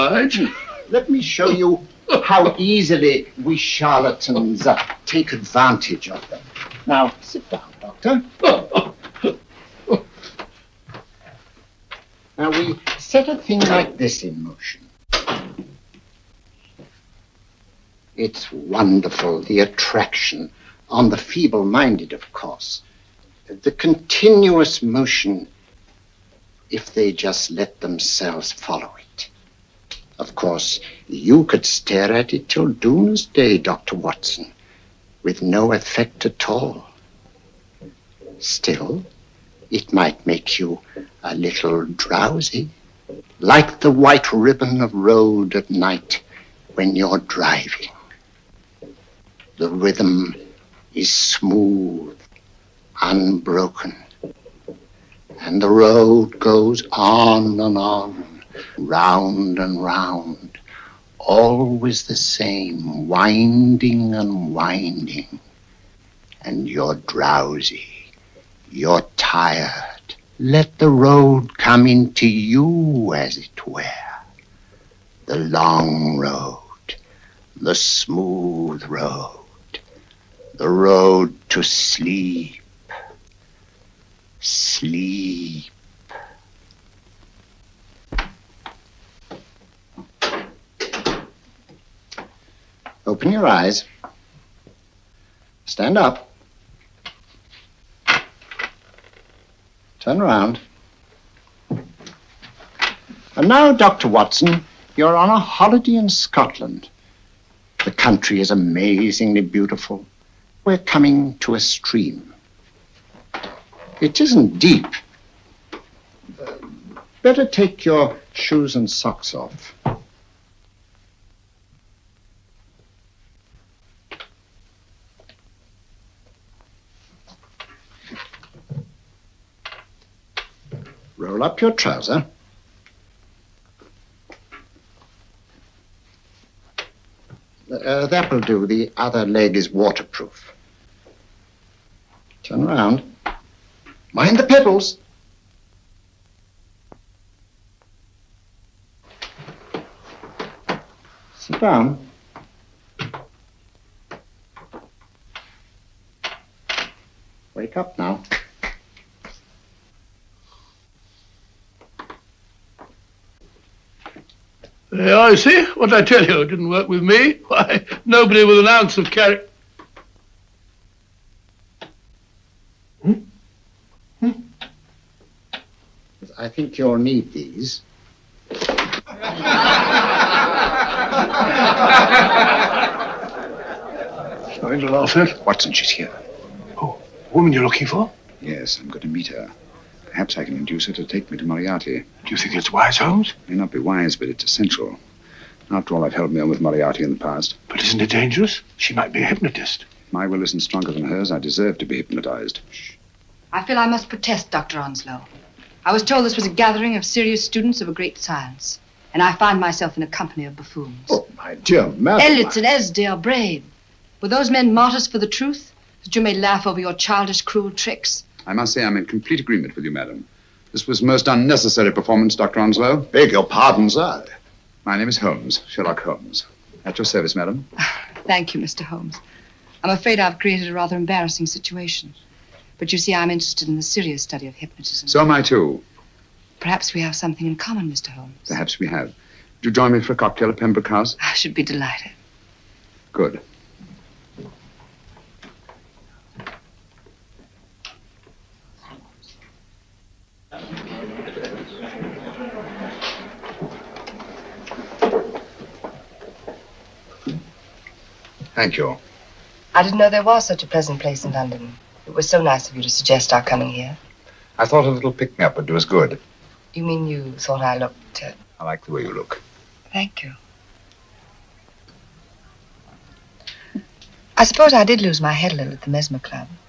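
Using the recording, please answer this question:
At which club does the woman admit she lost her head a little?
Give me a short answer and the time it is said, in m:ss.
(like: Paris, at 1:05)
Mesmer Club, at 4:35.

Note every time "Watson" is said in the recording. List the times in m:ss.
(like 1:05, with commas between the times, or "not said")
0:33, 1:44, 3:05.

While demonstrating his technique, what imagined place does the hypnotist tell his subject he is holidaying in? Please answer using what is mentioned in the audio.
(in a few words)
Scotland.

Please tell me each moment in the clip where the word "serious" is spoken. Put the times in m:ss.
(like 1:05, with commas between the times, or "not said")
3:27, 3:53.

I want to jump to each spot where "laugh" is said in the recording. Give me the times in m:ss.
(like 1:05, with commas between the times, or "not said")
3:04, 3:36.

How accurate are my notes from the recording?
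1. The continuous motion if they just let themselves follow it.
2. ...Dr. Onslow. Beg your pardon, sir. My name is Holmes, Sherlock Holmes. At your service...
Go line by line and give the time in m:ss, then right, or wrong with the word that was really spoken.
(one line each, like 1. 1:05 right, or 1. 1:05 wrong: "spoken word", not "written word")
1. 0:23 right
2. 3:42 right.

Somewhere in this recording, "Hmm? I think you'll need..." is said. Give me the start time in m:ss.
2:54.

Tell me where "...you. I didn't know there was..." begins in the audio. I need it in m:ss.
4:18.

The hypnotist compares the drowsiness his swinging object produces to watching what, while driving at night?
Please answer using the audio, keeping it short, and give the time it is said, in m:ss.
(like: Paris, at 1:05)
white ribbon of road, at 0:43.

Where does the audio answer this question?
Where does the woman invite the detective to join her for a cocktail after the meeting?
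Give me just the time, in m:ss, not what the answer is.
4:00.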